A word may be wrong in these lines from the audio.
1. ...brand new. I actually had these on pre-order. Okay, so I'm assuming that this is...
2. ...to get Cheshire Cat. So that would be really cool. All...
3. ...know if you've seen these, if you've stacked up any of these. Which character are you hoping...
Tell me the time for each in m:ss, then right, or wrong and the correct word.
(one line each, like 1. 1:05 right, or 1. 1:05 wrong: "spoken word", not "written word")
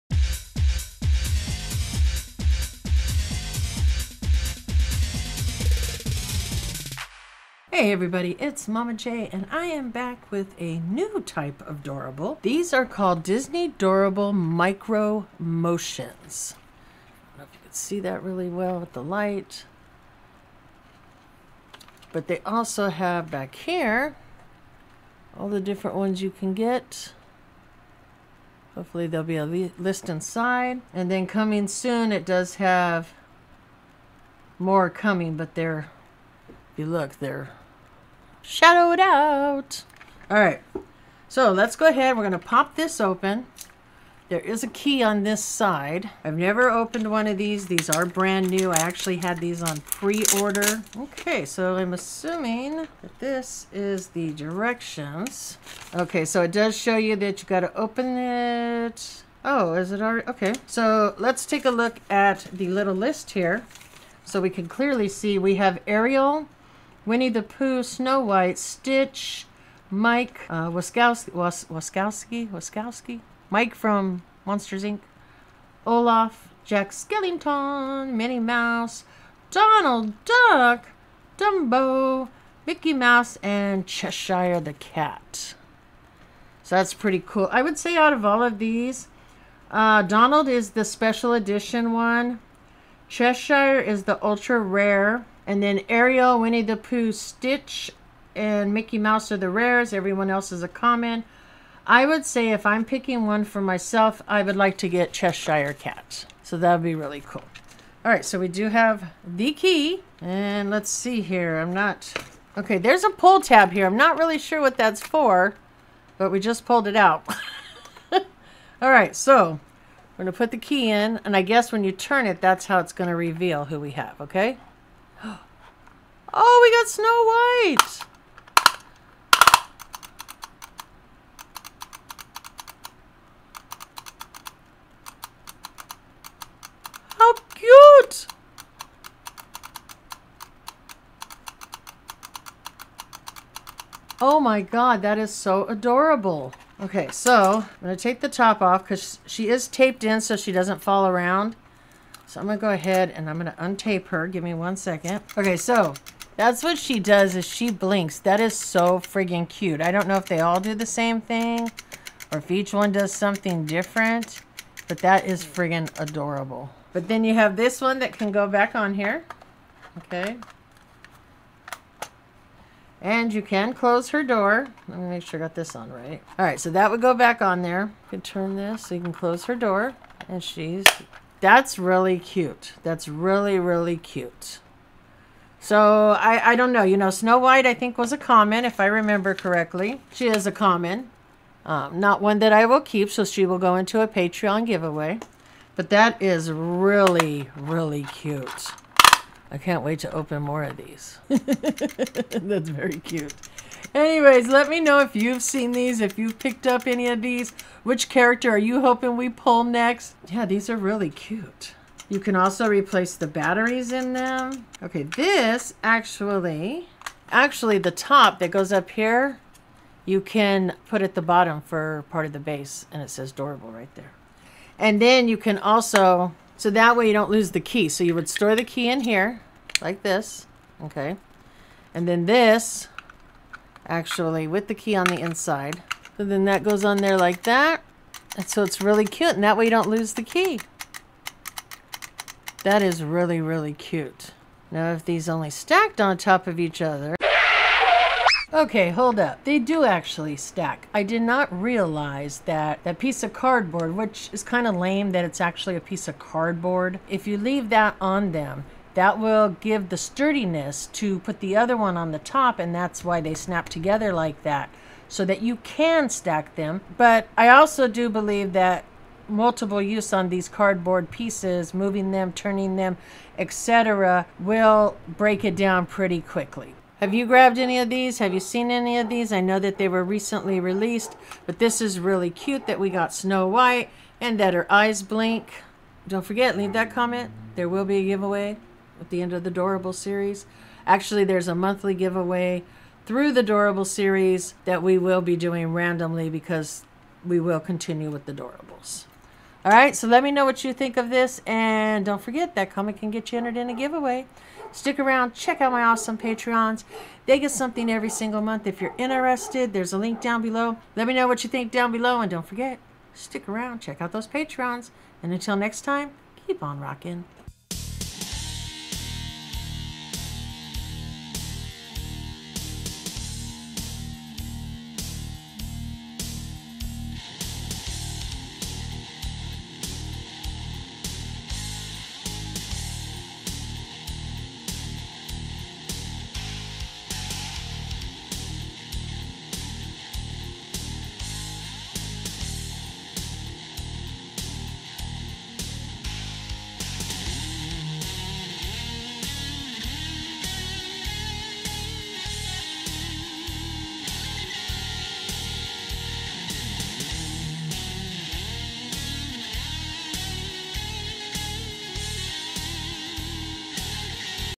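1. 0:48 right
2. 1:44 right
3. 3:24 wrong: "picked", not "stacked".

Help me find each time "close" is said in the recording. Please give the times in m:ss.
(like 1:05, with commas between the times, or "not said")
2:53, 2:59.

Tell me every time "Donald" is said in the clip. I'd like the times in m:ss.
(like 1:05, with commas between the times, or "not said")
1:19, 1:30.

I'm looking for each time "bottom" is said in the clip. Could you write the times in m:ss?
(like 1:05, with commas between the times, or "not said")
3:41.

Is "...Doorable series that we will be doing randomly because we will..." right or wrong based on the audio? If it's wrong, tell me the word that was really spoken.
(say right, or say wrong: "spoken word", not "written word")
right.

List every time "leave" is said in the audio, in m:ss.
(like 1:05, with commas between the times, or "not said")
4:17, 4:46.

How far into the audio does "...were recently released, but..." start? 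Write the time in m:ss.
4:39.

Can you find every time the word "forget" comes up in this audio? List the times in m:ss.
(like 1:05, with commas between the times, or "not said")
4:46, 5:02, 5:12.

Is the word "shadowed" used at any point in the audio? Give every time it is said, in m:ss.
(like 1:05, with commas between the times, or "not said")
0:38.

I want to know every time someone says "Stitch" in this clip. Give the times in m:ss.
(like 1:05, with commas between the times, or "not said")
1:08, 1:37.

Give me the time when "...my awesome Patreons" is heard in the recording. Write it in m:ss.
5:05.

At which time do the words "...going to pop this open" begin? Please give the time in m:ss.
0:42.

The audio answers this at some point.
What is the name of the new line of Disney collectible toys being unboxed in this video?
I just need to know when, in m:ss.
0:14.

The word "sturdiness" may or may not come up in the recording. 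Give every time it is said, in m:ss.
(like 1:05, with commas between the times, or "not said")
4:19.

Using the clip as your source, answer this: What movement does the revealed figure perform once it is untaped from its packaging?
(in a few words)
blinks.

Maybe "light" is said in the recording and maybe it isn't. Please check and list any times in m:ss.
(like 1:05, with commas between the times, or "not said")
0:19.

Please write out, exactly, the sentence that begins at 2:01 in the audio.
And I guess when you turn it, that's how it's going to reveal who we have, okay?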